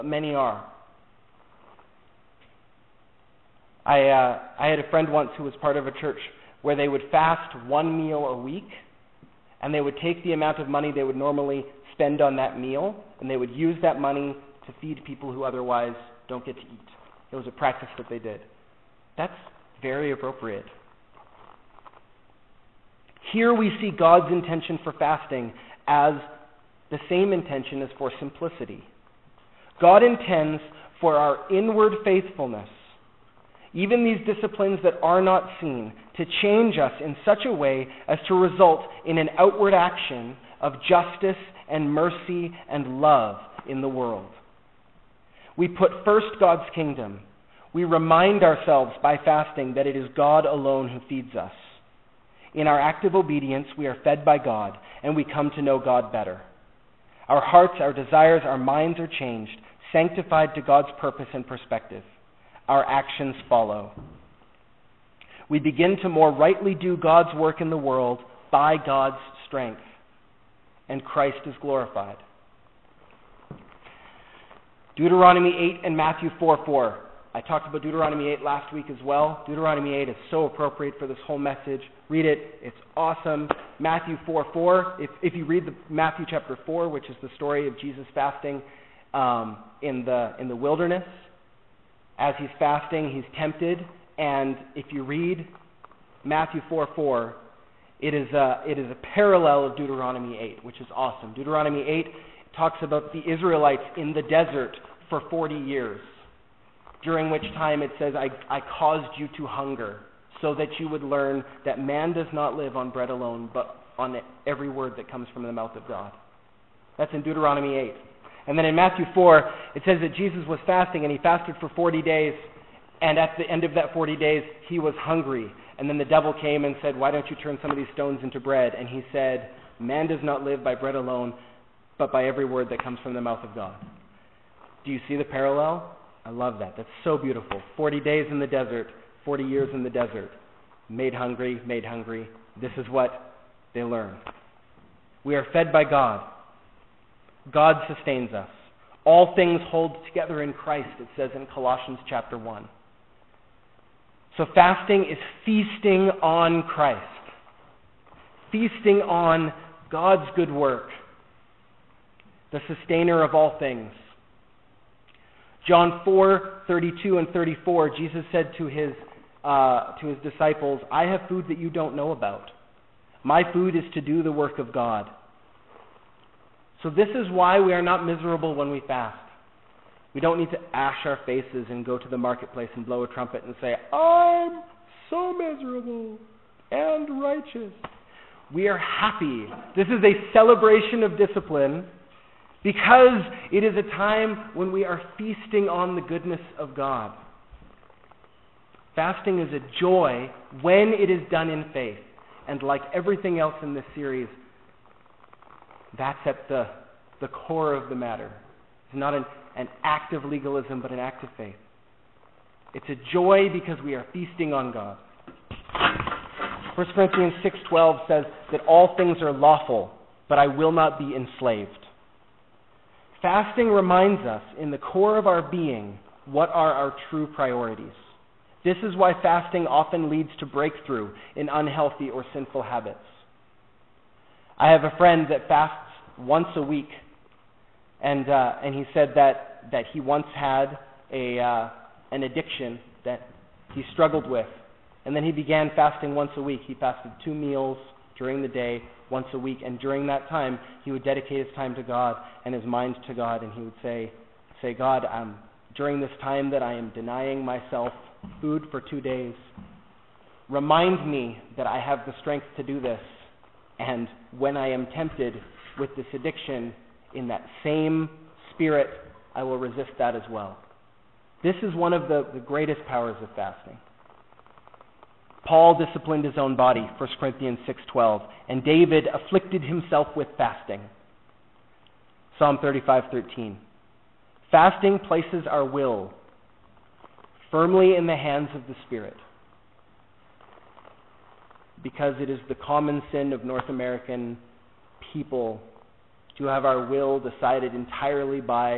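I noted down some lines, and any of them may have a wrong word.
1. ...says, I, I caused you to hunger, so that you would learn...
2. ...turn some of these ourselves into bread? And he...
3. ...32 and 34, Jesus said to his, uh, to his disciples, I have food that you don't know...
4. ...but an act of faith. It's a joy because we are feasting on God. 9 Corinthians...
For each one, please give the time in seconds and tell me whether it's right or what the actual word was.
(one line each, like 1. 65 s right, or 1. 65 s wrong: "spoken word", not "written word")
1. 108 s right
2. 127 s wrong: "stones", not "ourselves"
3. 166 s right
4. 210 s wrong: "1", not "9".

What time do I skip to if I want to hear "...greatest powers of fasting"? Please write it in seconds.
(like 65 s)
272 s.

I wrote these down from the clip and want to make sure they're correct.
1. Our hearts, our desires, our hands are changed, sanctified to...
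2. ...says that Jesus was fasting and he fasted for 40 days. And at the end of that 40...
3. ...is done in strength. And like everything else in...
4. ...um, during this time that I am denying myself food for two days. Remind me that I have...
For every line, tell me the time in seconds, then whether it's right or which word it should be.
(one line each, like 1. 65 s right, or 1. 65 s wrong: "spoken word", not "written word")
1. 57 s wrong: "minds", not "hands"
2. 119 s right
3. 201 s wrong: "faith", not "strength"
4. 255 s right.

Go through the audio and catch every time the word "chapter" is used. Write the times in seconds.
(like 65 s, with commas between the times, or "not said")
86 s, 152 s.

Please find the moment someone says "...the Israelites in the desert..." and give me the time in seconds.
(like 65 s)
103 s.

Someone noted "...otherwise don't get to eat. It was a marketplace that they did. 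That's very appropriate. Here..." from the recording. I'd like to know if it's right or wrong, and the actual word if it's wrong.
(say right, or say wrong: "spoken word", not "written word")
wrong: "practice", not "marketplace".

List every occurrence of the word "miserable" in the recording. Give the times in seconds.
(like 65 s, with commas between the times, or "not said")
178 s, 185 s.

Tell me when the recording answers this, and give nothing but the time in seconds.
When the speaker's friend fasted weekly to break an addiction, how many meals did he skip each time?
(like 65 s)
247 s.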